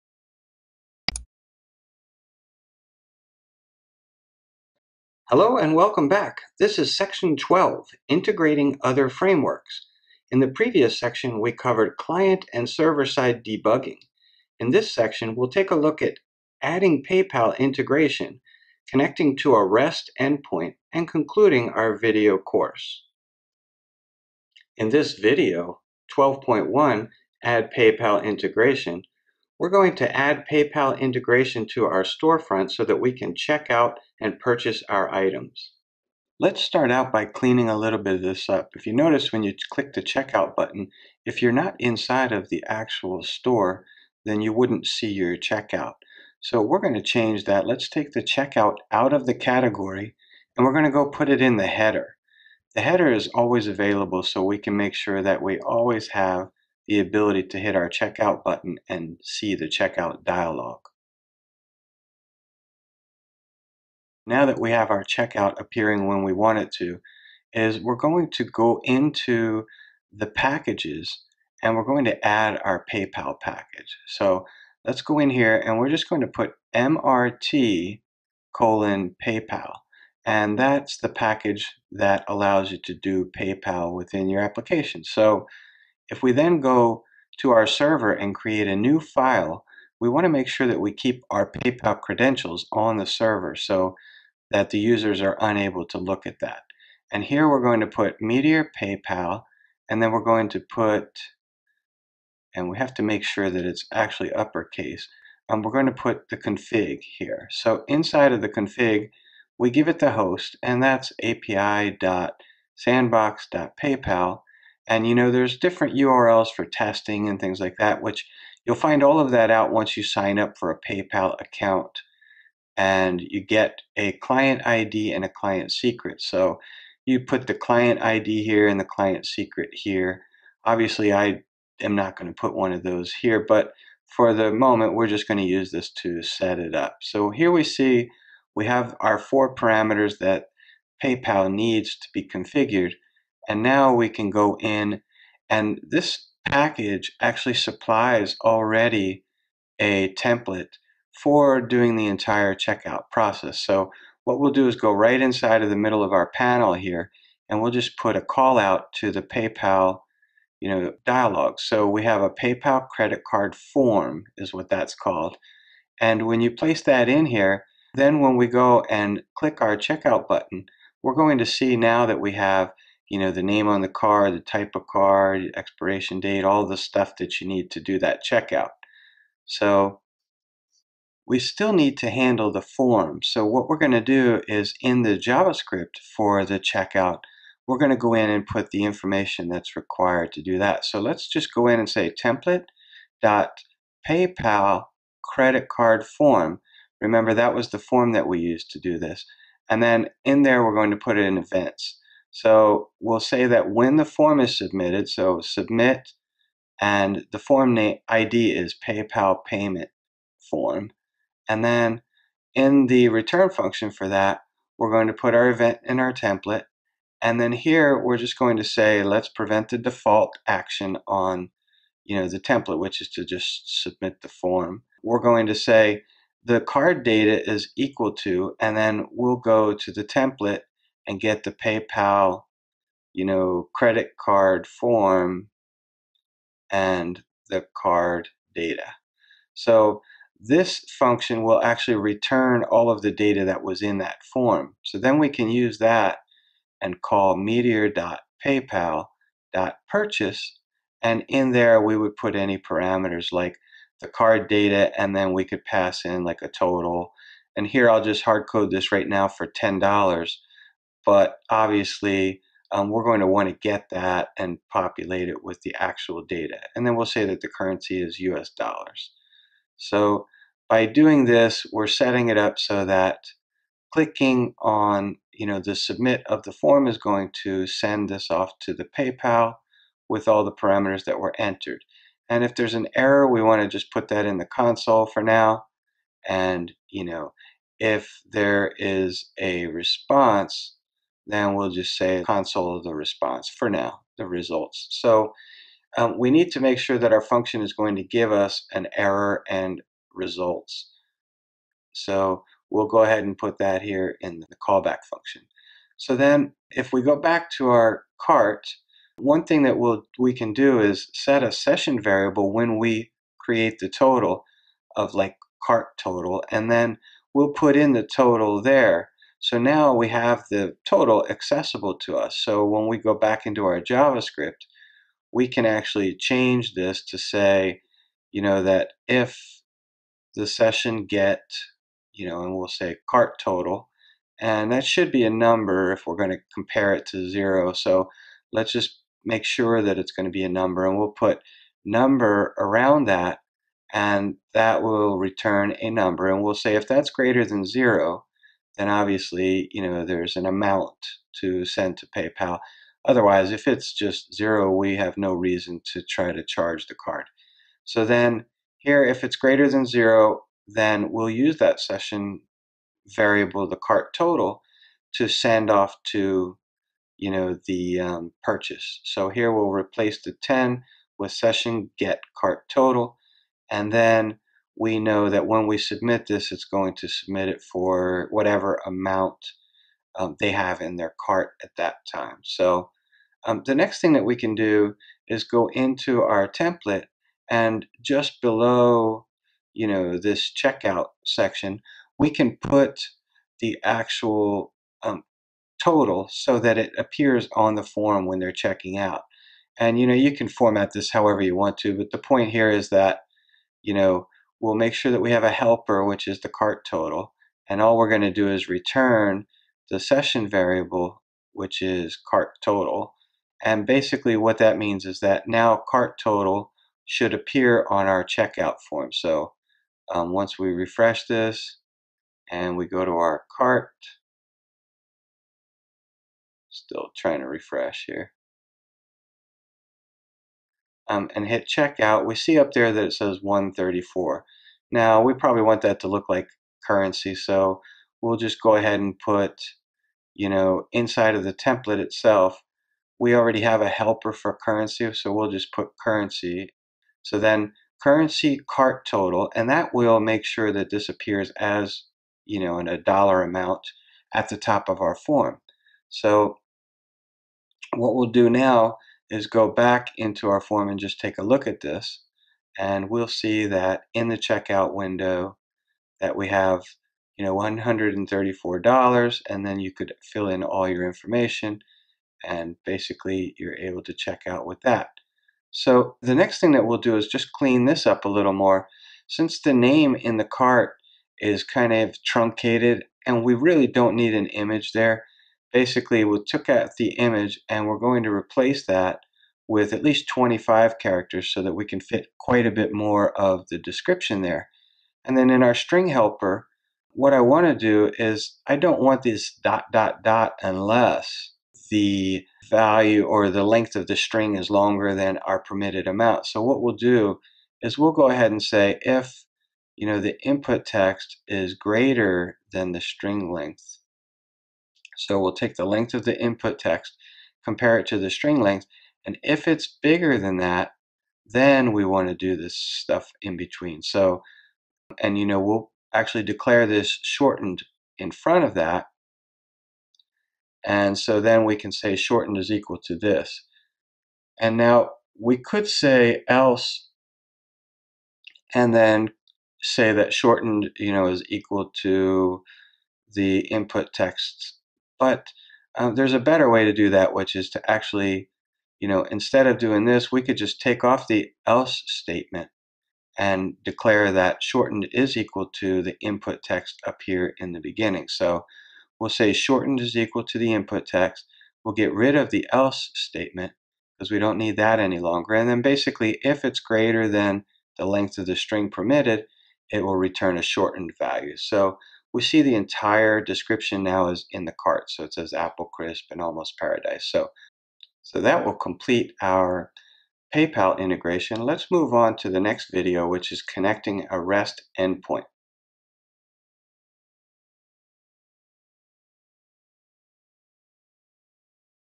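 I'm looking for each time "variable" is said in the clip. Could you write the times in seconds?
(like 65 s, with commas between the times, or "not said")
312 s, 363 s, 410 s.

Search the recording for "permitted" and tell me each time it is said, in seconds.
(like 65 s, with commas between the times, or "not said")
505 s, 568 s.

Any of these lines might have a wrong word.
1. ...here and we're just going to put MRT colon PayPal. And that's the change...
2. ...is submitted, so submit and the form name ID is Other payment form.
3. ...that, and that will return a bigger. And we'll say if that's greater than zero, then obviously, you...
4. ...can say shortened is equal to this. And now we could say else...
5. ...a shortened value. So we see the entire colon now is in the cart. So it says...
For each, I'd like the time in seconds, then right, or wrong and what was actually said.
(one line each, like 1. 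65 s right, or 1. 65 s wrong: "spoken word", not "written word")
1. 75 s wrong: "package", not "change"
2. 204 s wrong: "PayPal", not "Other"
3. 343 s wrong: "number", not "bigger"
4. 531 s right
5. 570 s wrong: "description", not "colon".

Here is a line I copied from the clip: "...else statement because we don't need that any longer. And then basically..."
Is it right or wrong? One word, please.
right.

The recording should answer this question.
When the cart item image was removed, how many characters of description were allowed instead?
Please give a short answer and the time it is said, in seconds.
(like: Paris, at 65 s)
25, at 490 s.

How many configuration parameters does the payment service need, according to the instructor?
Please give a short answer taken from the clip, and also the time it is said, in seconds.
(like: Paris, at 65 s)
4, at 139 s.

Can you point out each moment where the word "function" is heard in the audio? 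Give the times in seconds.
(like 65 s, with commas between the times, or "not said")
213 s, 240 s, 297 s, 305 s.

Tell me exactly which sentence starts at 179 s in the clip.
So we still need to handle the form.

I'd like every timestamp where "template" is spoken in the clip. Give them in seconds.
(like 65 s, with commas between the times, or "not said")
150 s, 192 s, 216 s, 222 s, 230 s, 386 s, 441 s.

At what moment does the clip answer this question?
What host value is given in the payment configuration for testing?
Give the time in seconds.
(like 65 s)
111 s.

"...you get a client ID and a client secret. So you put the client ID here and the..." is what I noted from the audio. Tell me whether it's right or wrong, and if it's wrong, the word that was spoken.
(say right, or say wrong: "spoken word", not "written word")
right.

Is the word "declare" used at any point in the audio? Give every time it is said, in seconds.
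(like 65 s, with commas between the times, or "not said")
526 s, 553 s.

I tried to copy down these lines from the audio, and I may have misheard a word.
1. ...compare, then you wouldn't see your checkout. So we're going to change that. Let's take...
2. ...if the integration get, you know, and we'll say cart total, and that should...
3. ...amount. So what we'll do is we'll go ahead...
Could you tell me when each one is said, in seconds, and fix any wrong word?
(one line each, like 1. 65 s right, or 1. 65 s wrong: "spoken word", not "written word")
1. 43 s wrong: "store", not "compare"
2. 329 s wrong: "session", not "integration"
3. 506 s right.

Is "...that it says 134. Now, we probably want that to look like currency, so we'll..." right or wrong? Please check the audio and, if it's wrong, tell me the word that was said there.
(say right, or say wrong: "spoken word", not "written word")
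right.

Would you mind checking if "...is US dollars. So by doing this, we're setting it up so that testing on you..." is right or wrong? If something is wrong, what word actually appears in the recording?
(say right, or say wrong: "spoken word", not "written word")
wrong: "clicking", not "testing".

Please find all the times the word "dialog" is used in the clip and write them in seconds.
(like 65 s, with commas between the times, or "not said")
60 s, 161 s.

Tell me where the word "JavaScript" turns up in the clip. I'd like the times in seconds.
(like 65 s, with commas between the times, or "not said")
185 s, 323 s.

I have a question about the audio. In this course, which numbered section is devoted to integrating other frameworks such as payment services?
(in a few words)
12.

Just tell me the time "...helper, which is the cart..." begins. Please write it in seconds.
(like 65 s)
405 s.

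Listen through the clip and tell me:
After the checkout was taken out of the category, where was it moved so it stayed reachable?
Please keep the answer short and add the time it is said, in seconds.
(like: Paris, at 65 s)
The header, at 51 s.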